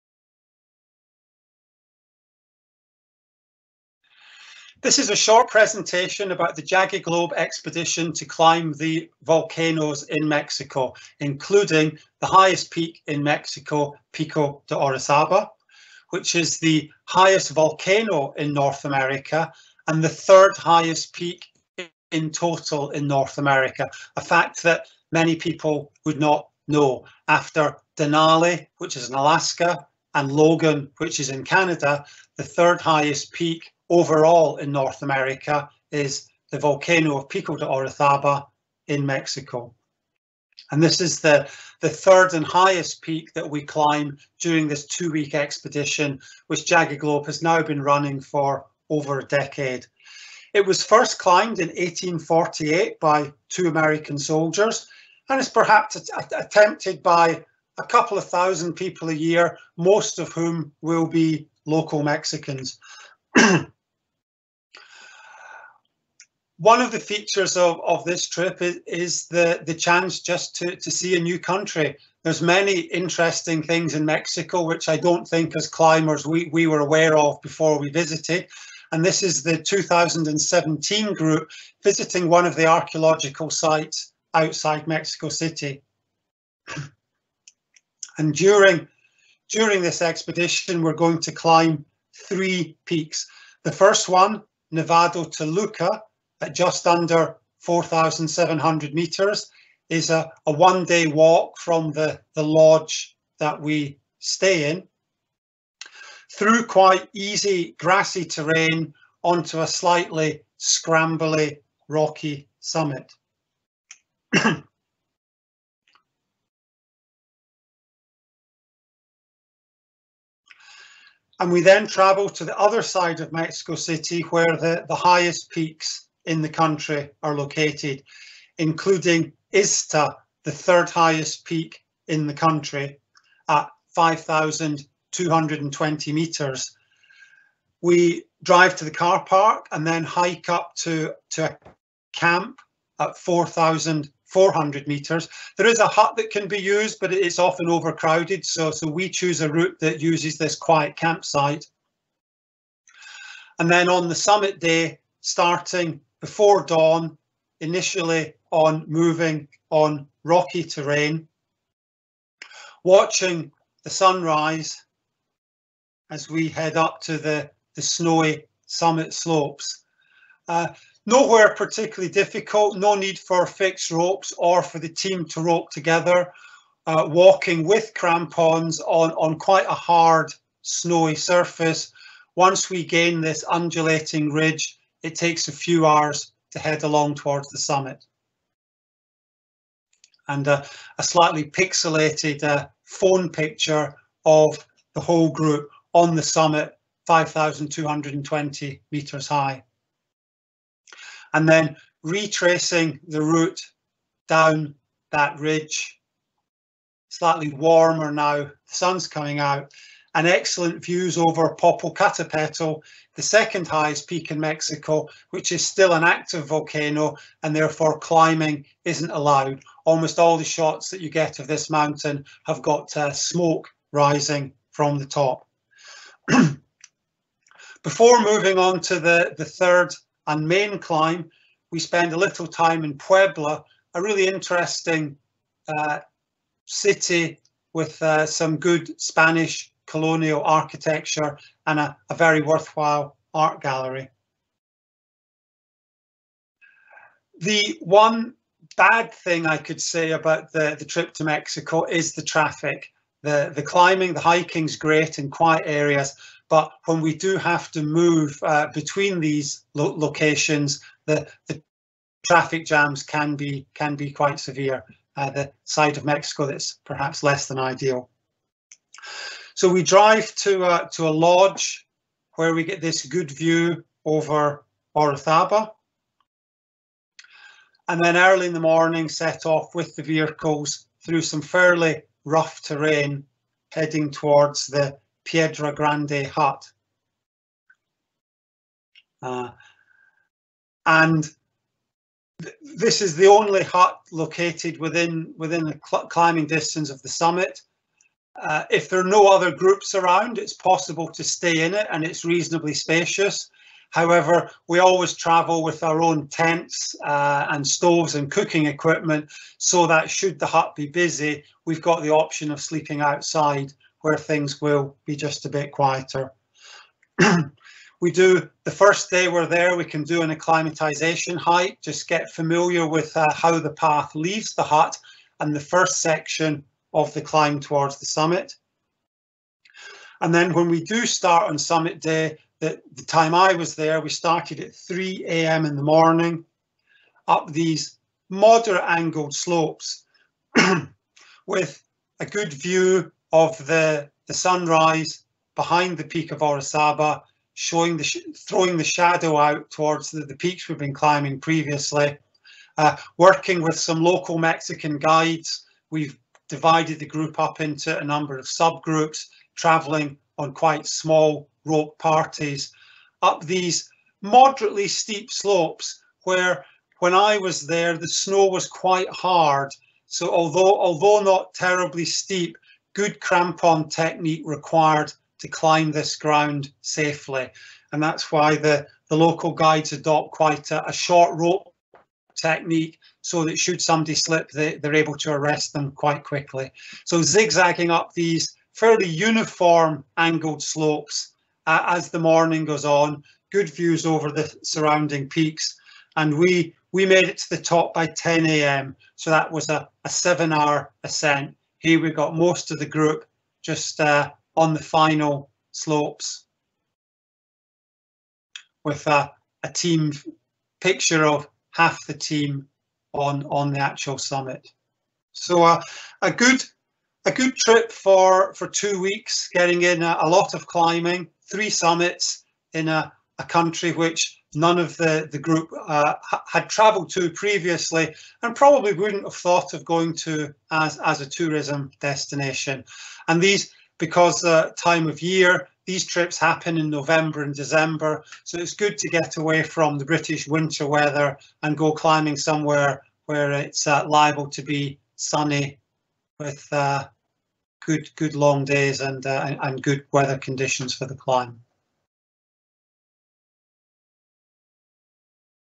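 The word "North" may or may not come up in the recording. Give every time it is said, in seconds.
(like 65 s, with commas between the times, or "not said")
18 s, 23 s, 34 s.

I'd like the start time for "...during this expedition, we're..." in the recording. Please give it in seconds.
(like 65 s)
89 s.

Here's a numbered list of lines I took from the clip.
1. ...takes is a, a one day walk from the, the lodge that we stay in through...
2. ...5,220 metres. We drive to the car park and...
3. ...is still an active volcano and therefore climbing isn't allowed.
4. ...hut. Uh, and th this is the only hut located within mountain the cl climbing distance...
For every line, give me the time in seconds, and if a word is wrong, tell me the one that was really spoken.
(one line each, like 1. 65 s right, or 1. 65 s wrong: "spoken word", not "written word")
1. 98 s wrong: "metres", not "takes"
2. 133 s right
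3. 215 s right
4. 286 s wrong: "within", not "mountain".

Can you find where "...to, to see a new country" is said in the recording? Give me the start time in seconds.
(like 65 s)
70 s.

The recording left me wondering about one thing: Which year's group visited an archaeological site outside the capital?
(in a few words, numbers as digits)
2017.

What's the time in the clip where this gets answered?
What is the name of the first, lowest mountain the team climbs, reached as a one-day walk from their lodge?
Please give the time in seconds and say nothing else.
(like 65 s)
94 s.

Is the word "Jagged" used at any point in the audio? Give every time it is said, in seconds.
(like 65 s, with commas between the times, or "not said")
6 s, 46 s.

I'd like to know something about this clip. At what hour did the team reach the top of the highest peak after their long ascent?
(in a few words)
10 a.m.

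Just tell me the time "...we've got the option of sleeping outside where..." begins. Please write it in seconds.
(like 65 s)
311 s.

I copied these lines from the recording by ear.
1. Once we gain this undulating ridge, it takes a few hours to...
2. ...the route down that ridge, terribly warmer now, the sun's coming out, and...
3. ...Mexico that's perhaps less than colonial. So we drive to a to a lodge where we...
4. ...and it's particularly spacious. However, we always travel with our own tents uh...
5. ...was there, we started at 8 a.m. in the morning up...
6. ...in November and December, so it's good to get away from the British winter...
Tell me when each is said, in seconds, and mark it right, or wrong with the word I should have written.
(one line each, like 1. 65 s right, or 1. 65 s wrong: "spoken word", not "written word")
1. 182 s right
2. 203 s wrong: "slightly", not "terribly"
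3. 266 s wrong: "ideal", not "colonial"
4. 301 s wrong: "reasonably", not "particularly"
5. 333 s wrong: "3", not "8"
6. 436 s right.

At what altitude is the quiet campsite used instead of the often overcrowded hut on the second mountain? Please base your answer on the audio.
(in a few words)
4,400 metres.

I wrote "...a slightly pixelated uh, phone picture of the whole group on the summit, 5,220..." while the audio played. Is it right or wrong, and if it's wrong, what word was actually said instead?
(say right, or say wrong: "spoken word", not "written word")
right.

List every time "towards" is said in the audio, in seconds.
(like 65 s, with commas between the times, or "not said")
187 s, 284 s, 327 s, 349 s.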